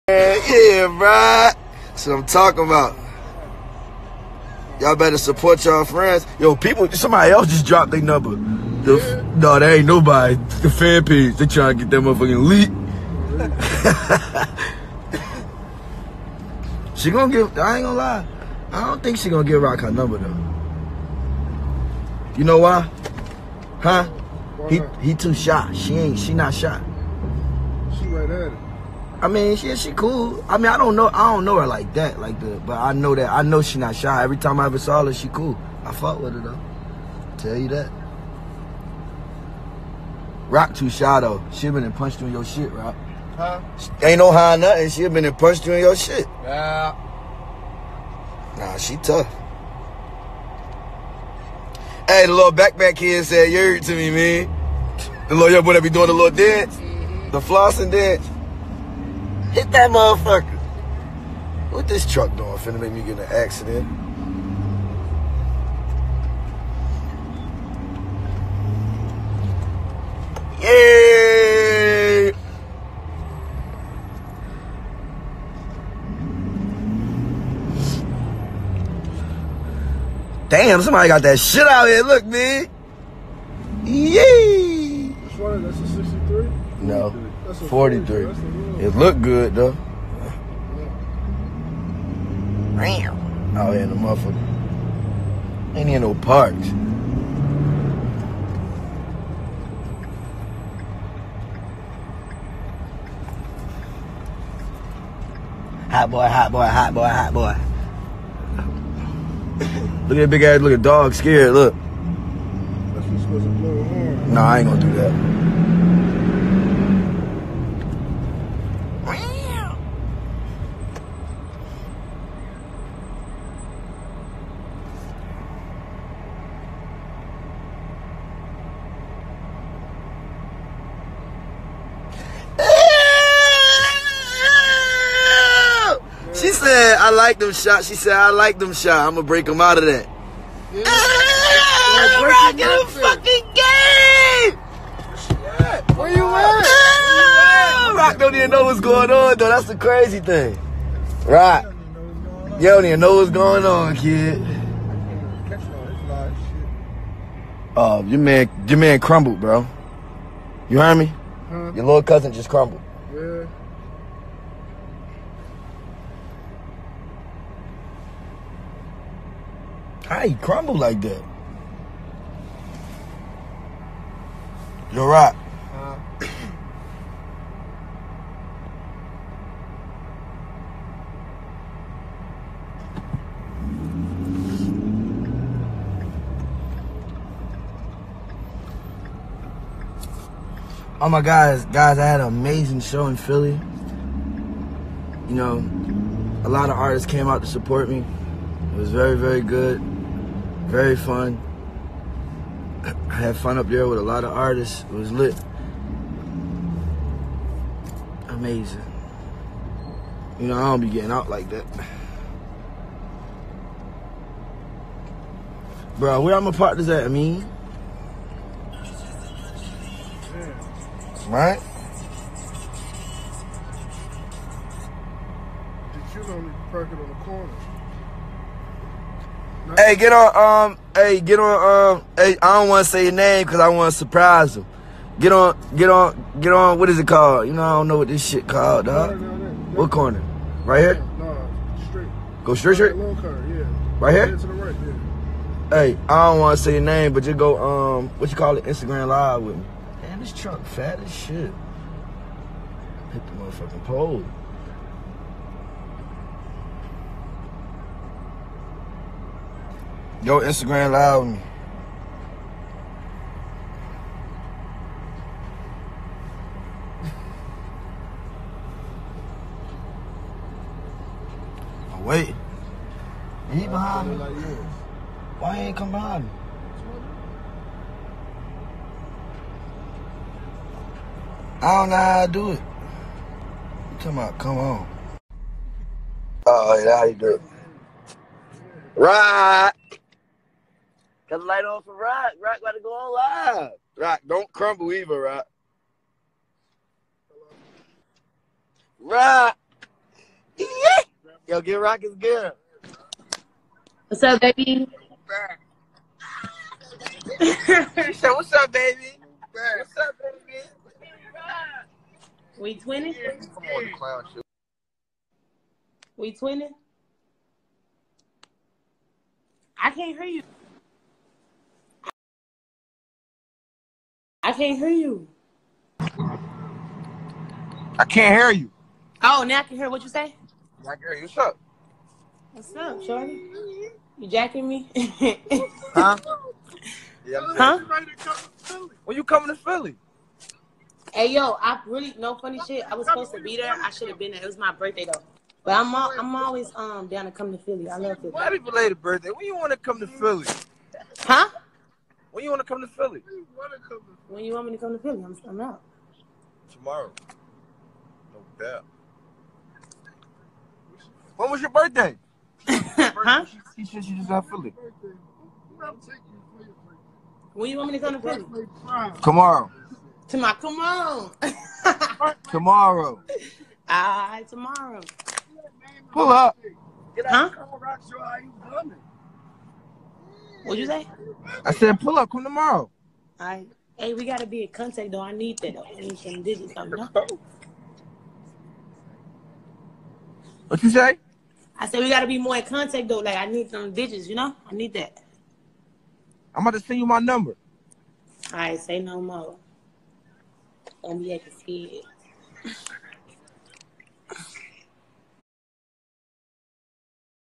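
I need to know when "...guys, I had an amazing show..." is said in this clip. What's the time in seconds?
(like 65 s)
191 s.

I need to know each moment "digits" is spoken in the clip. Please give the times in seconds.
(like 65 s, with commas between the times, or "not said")
386 s, 393 s.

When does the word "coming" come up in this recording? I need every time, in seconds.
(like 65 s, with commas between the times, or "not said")
339 s.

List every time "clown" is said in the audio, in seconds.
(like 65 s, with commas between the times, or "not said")
313 s.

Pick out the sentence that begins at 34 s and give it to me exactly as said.
Every time I ever saw her, she cool.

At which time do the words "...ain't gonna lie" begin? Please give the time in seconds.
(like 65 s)
17 s.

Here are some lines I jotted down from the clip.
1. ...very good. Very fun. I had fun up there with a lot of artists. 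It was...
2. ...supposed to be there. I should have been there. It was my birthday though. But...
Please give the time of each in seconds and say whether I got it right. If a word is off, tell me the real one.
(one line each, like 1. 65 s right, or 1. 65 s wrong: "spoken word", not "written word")
1. 199 s right
2. 343 s right.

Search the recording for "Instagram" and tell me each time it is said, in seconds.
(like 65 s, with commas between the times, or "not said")
248 s, 260 s.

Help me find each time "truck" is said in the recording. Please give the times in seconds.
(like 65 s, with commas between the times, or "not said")
62 s, 250 s.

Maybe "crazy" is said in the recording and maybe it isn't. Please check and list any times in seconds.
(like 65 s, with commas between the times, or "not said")
149 s.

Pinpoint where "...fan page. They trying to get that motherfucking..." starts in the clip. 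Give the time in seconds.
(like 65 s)
10 s.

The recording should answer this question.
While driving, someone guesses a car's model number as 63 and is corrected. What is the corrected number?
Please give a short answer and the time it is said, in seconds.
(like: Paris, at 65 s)
43, at 87 s.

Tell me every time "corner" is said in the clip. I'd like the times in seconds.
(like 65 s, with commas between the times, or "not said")
227 s, 239 s.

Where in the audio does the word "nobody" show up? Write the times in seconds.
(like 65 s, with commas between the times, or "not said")
9 s.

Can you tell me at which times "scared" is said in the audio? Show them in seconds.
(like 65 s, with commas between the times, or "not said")
111 s, 402 s.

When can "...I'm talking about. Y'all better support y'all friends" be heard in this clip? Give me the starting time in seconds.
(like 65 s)
2 s.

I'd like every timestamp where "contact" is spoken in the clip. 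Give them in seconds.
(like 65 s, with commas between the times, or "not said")
384 s, 392 s.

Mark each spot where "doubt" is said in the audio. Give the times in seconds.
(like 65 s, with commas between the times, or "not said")
358 s.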